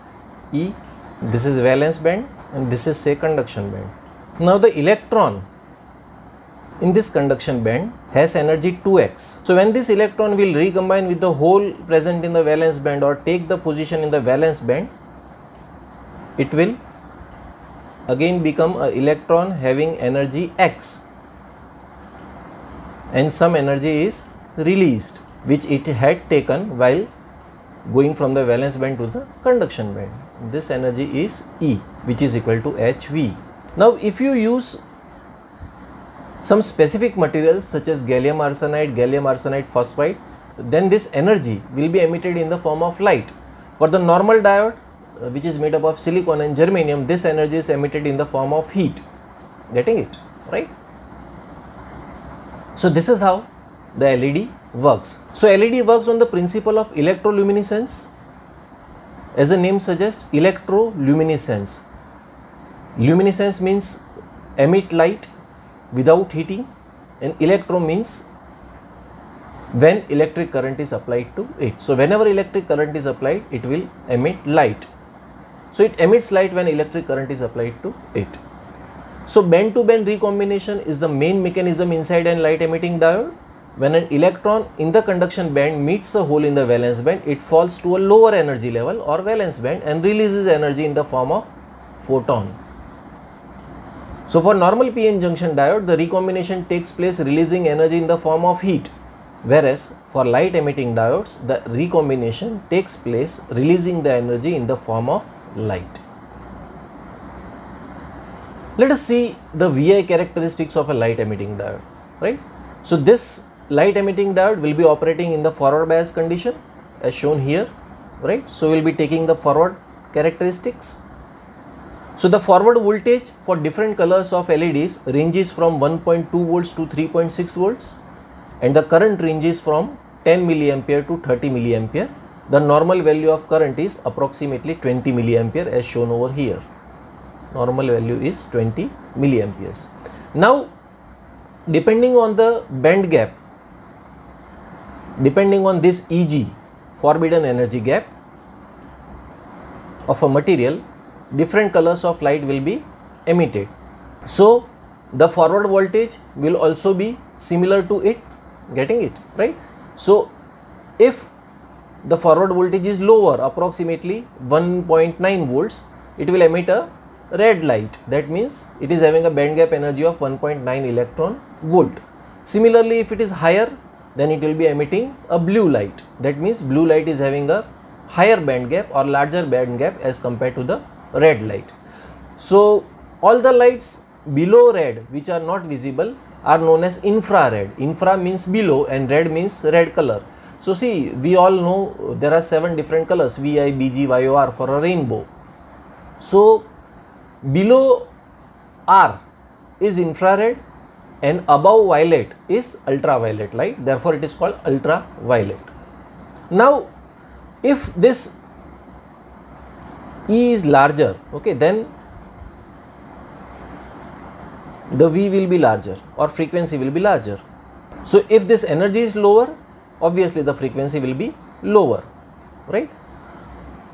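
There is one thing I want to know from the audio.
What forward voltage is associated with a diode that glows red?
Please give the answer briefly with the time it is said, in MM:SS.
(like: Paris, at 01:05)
1.9 volts, at 02:44.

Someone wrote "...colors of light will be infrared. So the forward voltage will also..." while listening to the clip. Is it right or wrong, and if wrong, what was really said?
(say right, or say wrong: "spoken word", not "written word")
wrong: "emitted", not "infrared".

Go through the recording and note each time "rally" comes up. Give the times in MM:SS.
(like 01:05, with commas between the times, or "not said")
not said.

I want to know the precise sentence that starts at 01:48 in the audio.
Let us see the VI characteristics of a light emitting diode, right?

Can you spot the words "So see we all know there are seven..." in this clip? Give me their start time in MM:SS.
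03:10.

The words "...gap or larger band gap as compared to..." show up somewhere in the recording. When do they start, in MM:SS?
02:58.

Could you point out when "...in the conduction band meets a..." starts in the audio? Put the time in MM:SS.
01:24.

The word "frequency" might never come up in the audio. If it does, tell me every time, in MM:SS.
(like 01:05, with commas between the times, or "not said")
03:36, 03:40.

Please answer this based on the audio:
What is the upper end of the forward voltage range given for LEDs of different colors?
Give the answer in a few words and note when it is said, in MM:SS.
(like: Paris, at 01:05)
3.6 volts, at 02:06.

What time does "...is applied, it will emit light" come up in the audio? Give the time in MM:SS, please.
01:12.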